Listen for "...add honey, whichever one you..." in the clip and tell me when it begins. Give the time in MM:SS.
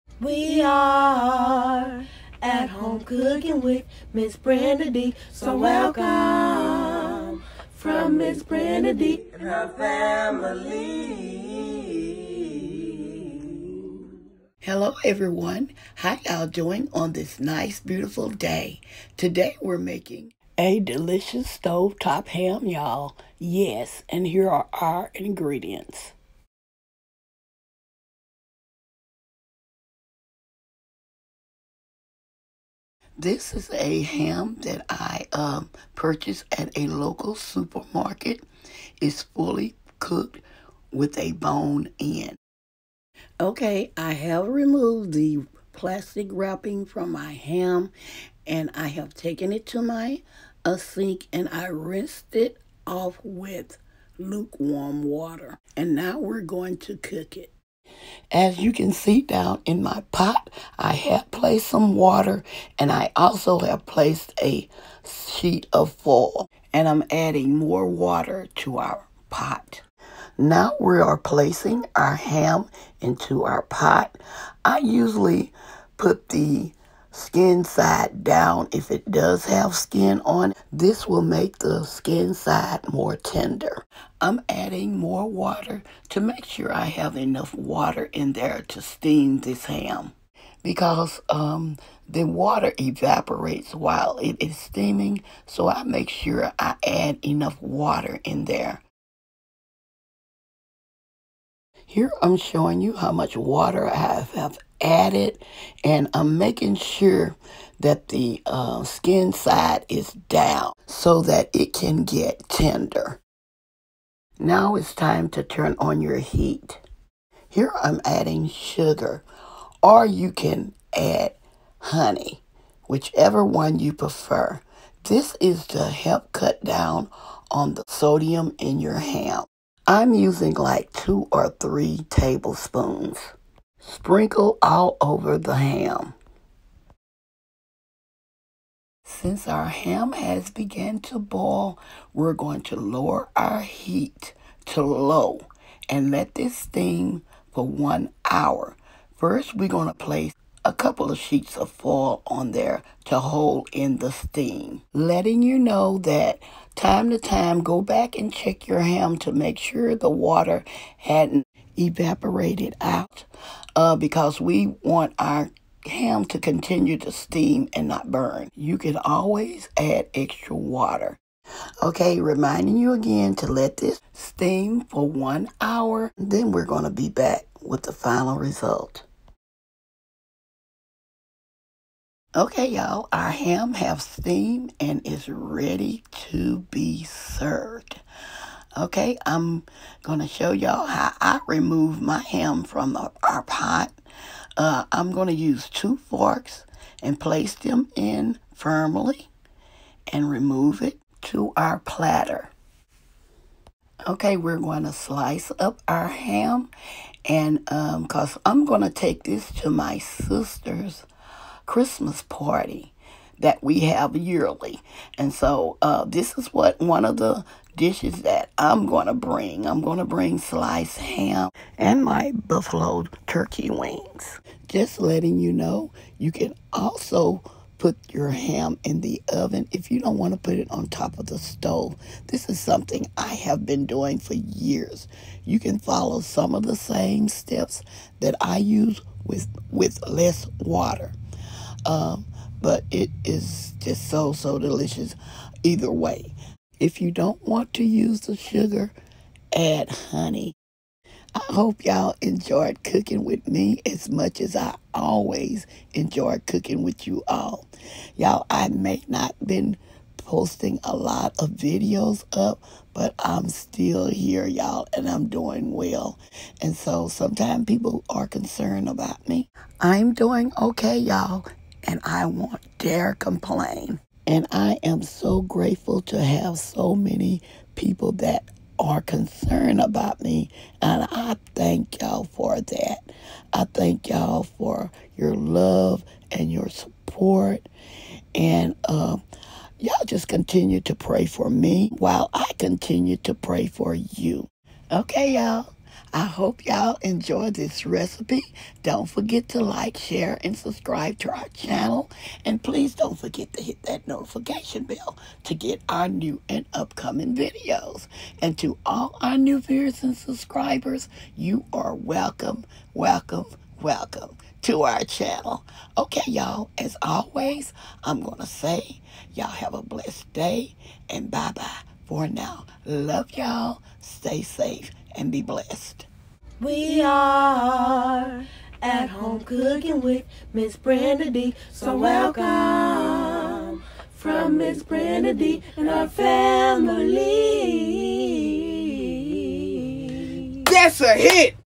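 02:00.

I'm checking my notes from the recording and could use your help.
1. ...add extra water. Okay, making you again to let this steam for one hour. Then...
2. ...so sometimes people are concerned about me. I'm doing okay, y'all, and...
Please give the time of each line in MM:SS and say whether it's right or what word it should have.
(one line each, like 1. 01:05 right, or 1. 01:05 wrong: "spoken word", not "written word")
1. 02:49 wrong: "reminding", not "making"
2. 04:26 right.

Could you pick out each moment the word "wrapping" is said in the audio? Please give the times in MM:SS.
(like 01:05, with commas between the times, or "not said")
00:46.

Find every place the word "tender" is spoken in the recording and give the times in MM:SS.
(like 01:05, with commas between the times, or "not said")
01:23, 01:52.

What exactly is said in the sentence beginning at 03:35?
And so uh, this is what one of the dishes that I'm going to bring.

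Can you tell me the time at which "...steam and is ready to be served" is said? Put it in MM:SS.
03:04.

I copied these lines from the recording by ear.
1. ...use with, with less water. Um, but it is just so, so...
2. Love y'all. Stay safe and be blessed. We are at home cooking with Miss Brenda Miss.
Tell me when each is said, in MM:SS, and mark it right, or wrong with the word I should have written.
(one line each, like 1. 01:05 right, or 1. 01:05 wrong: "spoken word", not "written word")
1. 03:58 right
2. 05:22 wrong: "Dee", not "Miss".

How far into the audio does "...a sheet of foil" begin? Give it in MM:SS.
01:04.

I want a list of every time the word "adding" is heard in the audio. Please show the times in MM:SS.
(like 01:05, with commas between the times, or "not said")
01:07, 01:24, 01:58.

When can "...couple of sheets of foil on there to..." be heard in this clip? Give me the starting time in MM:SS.
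02:30.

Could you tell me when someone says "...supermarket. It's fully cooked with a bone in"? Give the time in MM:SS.
00:37.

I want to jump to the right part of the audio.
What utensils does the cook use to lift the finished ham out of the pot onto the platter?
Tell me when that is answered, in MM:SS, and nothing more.
03:15.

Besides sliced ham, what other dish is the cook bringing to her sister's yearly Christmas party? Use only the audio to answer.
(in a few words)
Buffalo turkey wings.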